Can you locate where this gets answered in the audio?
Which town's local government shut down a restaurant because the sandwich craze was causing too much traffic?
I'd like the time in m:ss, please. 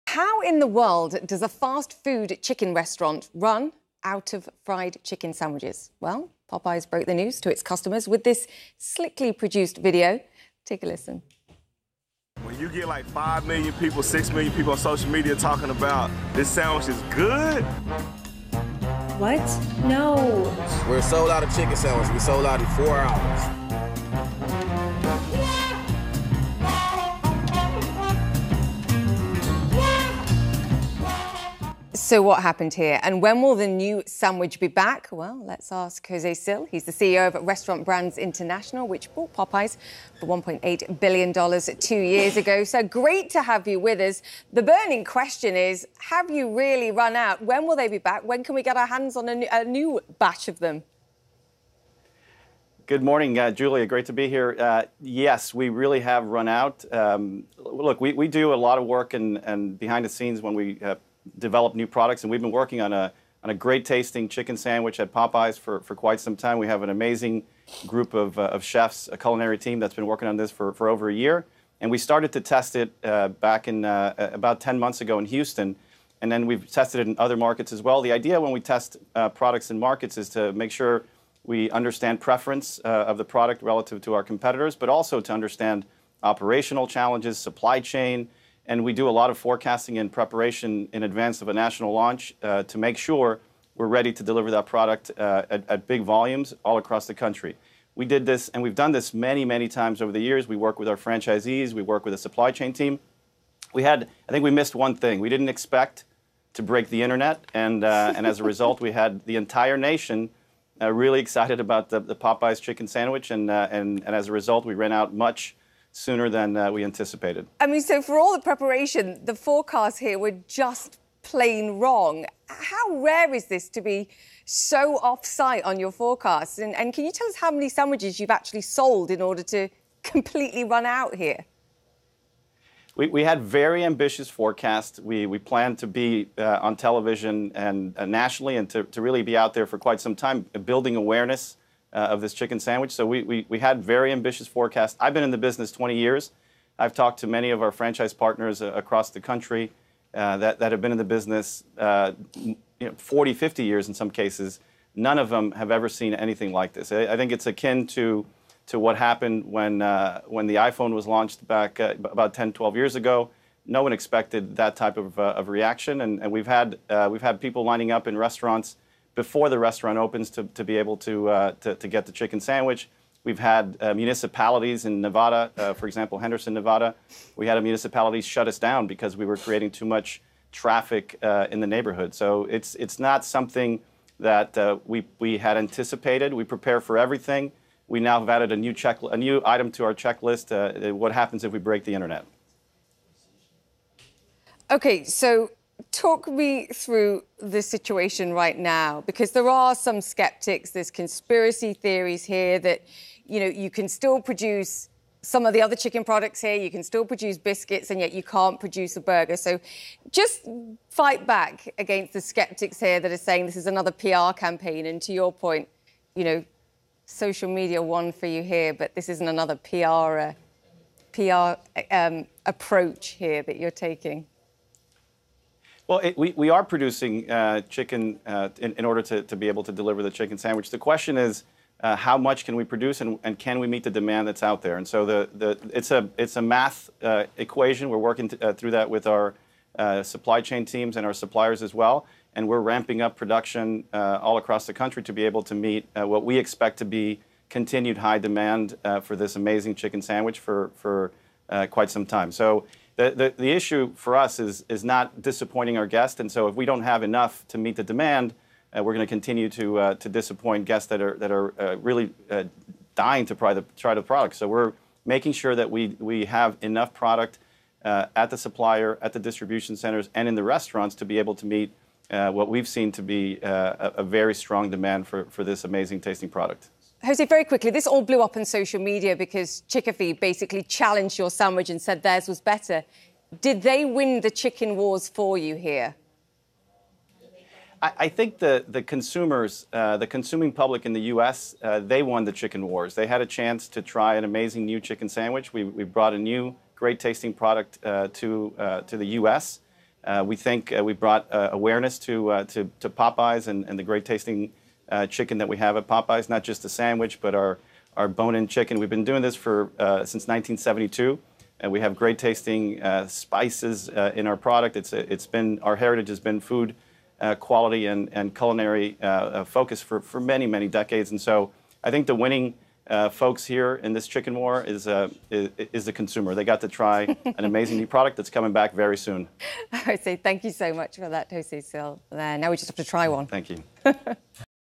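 2:56.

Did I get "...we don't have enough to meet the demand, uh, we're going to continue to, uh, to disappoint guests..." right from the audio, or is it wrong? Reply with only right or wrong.
right.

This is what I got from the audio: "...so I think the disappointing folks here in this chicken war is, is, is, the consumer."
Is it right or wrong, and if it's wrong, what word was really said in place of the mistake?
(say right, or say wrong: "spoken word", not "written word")
wrong: "winning", not "disappointing".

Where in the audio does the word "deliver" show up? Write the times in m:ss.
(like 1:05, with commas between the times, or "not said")
1:34, 3:49.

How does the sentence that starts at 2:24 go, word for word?
I've been in the business 20 years.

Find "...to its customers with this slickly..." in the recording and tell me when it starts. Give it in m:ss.
0:07.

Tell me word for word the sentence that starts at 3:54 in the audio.
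And so the, the, it's, a, it's a math uh, equation.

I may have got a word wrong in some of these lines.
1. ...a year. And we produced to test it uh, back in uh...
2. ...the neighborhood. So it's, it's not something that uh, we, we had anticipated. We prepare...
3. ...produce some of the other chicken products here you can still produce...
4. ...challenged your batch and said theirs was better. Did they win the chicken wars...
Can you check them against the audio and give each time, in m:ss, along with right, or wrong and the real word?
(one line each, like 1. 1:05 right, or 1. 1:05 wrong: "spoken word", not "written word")
1. 1:11 wrong: "started", not "produced"
2. 3:01 right
3. 3:24 right
4. 4:40 wrong: "sandwich", not "batch".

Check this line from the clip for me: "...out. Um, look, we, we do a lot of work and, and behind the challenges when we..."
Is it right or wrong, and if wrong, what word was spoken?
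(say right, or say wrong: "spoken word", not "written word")
wrong: "scenes", not "challenges".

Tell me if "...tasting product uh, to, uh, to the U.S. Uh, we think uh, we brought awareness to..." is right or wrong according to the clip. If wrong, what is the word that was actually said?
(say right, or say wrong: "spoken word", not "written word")
right.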